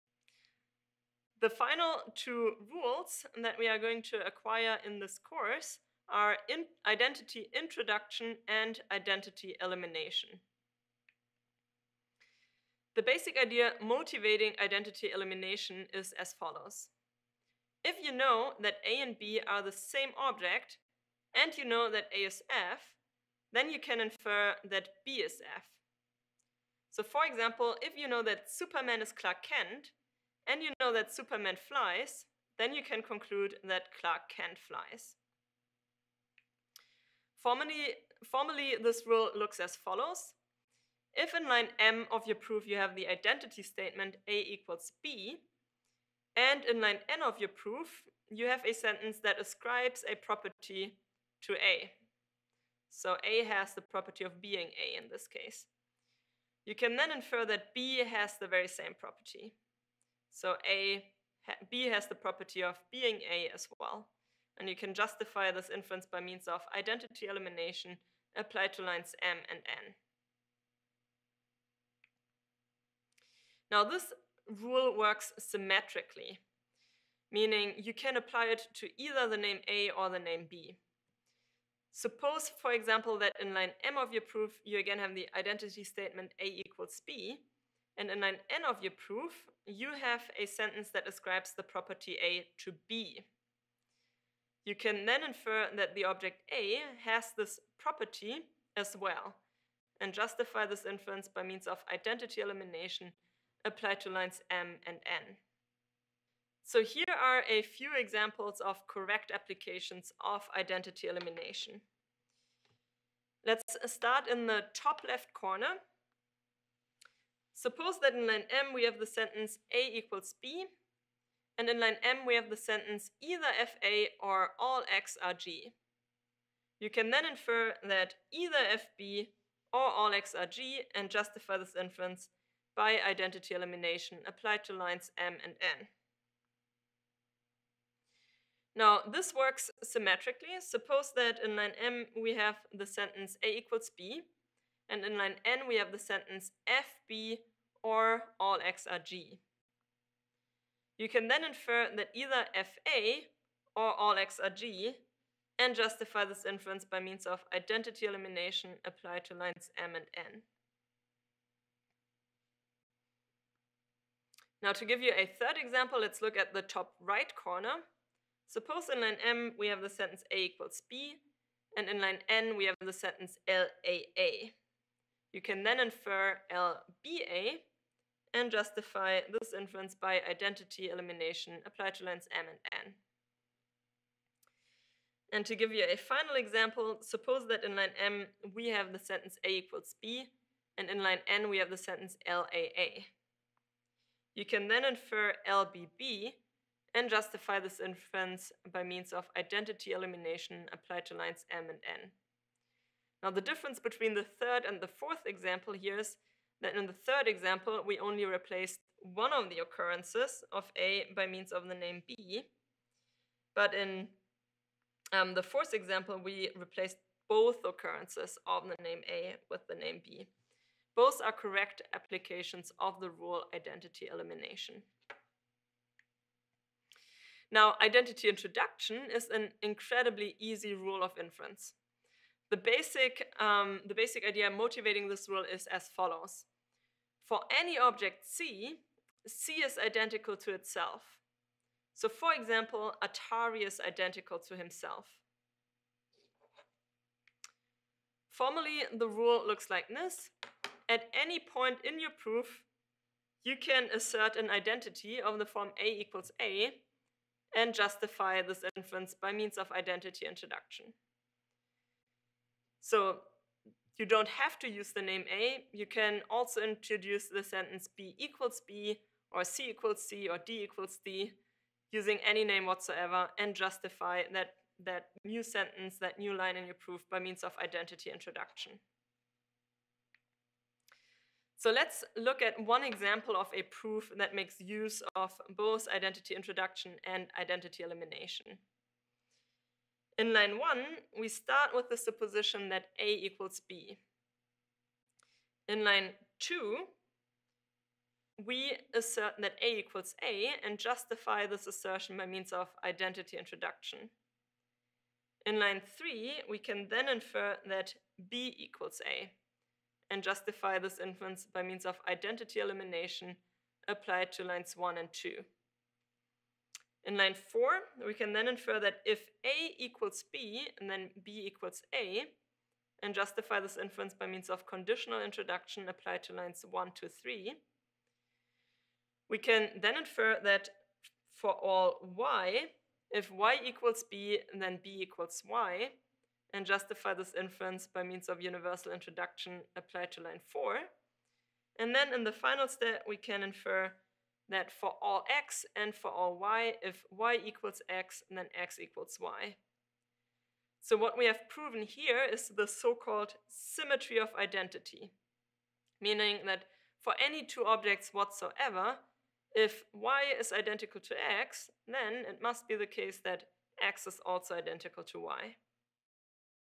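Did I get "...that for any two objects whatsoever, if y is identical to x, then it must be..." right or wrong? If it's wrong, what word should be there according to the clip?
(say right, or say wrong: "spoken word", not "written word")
right.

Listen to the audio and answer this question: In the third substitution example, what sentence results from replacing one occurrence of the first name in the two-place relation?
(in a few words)
LBA.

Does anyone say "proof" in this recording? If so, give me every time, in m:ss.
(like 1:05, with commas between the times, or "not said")
0:42, 0:47, 1:24, 1:28, 4:12, 4:36, 4:43.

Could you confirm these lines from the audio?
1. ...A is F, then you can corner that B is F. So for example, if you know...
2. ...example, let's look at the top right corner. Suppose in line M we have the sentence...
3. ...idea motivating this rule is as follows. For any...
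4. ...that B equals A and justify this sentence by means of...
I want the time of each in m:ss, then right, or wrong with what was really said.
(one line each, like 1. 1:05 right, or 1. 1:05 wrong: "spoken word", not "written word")
1. 0:22 wrong: "infer", not "corner"
2. 2:45 right
3. 3:54 right
4. 5:07 wrong: "inference", not "sentence".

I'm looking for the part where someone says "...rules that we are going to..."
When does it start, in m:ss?
0:02.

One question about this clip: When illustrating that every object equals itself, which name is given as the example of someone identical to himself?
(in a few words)
Atari.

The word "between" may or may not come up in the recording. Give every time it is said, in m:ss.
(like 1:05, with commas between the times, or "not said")
3:23.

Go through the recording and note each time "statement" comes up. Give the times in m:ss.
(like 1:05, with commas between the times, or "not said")
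0:43, 1:25.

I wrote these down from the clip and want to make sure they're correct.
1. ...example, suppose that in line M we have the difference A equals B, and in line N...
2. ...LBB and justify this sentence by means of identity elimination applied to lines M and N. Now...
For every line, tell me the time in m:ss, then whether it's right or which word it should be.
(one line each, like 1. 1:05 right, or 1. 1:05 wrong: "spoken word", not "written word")
1. 3:06 wrong: "sentence", not "difference"
2. 3:15 wrong: "inference", not "sentence".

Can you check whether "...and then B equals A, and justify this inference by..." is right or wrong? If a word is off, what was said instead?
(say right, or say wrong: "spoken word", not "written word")
right.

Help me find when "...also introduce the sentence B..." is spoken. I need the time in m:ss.
4:26.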